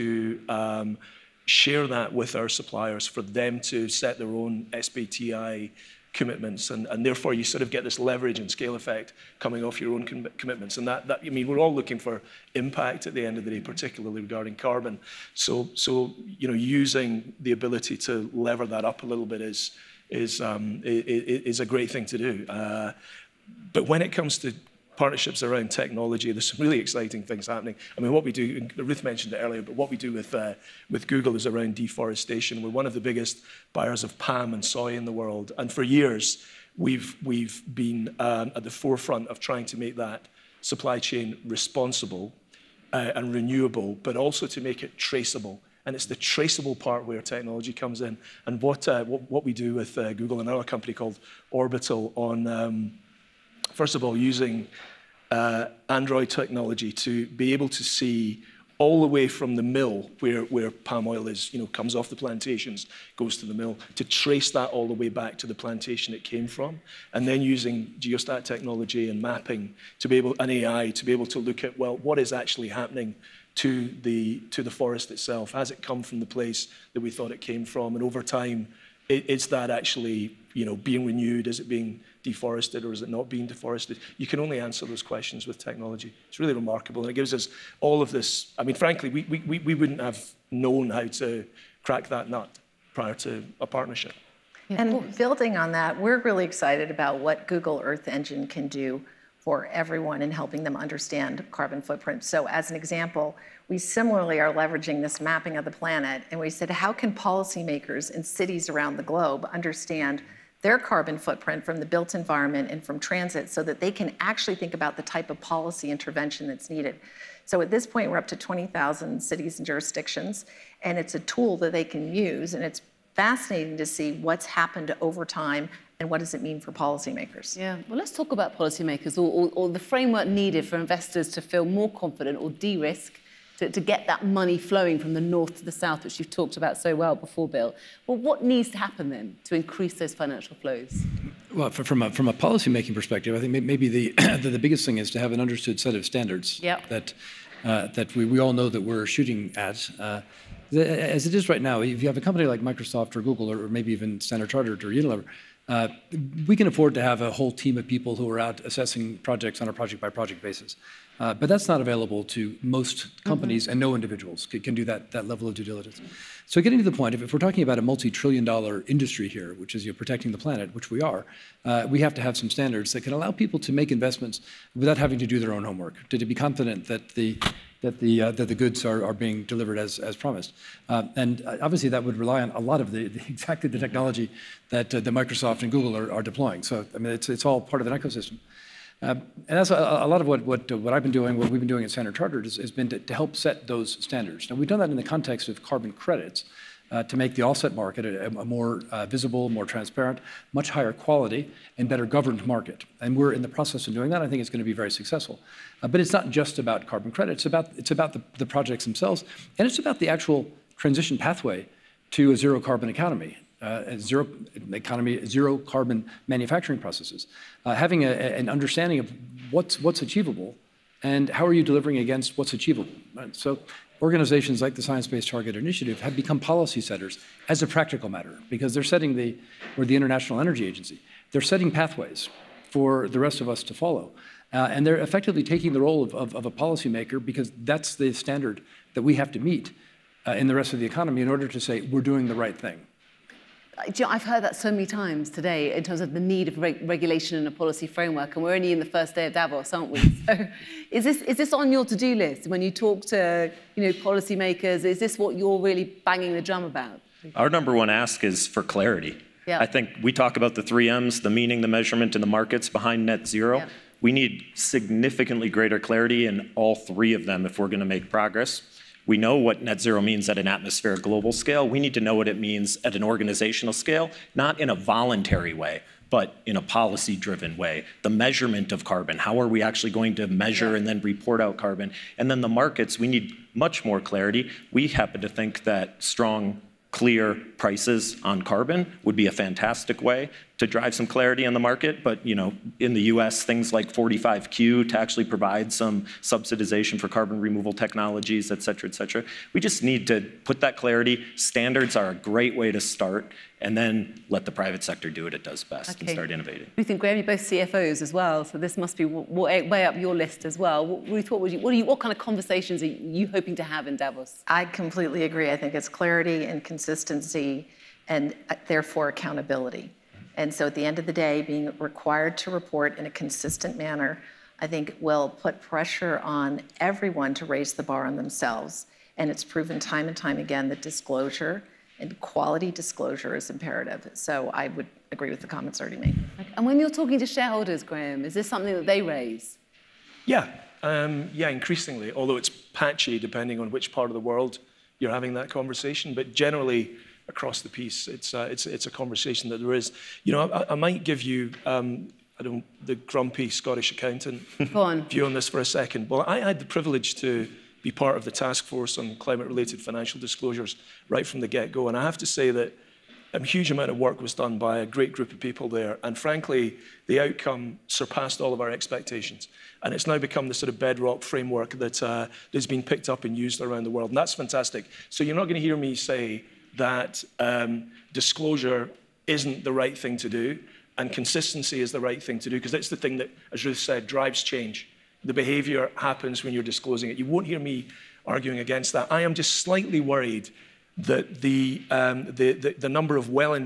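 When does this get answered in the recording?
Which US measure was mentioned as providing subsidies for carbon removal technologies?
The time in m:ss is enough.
4:53.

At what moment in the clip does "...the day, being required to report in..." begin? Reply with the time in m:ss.
5:21.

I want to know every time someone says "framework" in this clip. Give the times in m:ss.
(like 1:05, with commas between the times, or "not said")
2:09, 4:07, 6:11.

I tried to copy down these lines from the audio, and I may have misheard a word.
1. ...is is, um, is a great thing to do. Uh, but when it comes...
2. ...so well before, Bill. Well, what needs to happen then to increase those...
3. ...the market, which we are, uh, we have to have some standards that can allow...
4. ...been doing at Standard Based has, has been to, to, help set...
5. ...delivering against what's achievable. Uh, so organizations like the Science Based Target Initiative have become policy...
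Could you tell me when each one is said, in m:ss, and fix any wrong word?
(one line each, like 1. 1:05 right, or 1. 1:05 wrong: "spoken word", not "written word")
1. 0:19 right
2. 2:16 right
3. 2:50 wrong: "planet", not "market"
4. 3:11 wrong: "Chartered", not "Based"
5. 3:41 right.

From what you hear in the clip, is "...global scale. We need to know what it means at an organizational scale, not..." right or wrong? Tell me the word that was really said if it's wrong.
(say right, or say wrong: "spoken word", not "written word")
right.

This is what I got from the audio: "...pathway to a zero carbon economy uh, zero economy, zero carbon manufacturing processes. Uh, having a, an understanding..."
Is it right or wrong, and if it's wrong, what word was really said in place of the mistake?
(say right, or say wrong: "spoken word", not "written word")
right.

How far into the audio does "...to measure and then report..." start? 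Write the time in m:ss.
4:40.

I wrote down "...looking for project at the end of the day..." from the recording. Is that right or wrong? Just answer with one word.
wrong.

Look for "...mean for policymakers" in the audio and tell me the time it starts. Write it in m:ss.
2:06.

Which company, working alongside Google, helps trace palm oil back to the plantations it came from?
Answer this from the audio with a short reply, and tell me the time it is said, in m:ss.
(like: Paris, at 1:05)
Orbital, at 0:51.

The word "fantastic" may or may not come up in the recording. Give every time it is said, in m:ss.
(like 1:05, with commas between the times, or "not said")
4:49, 6:14.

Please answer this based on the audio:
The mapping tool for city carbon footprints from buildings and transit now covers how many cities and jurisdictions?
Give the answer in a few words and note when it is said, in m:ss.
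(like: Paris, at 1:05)
20,000, at 1:58.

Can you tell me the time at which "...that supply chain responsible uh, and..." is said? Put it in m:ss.
0:39.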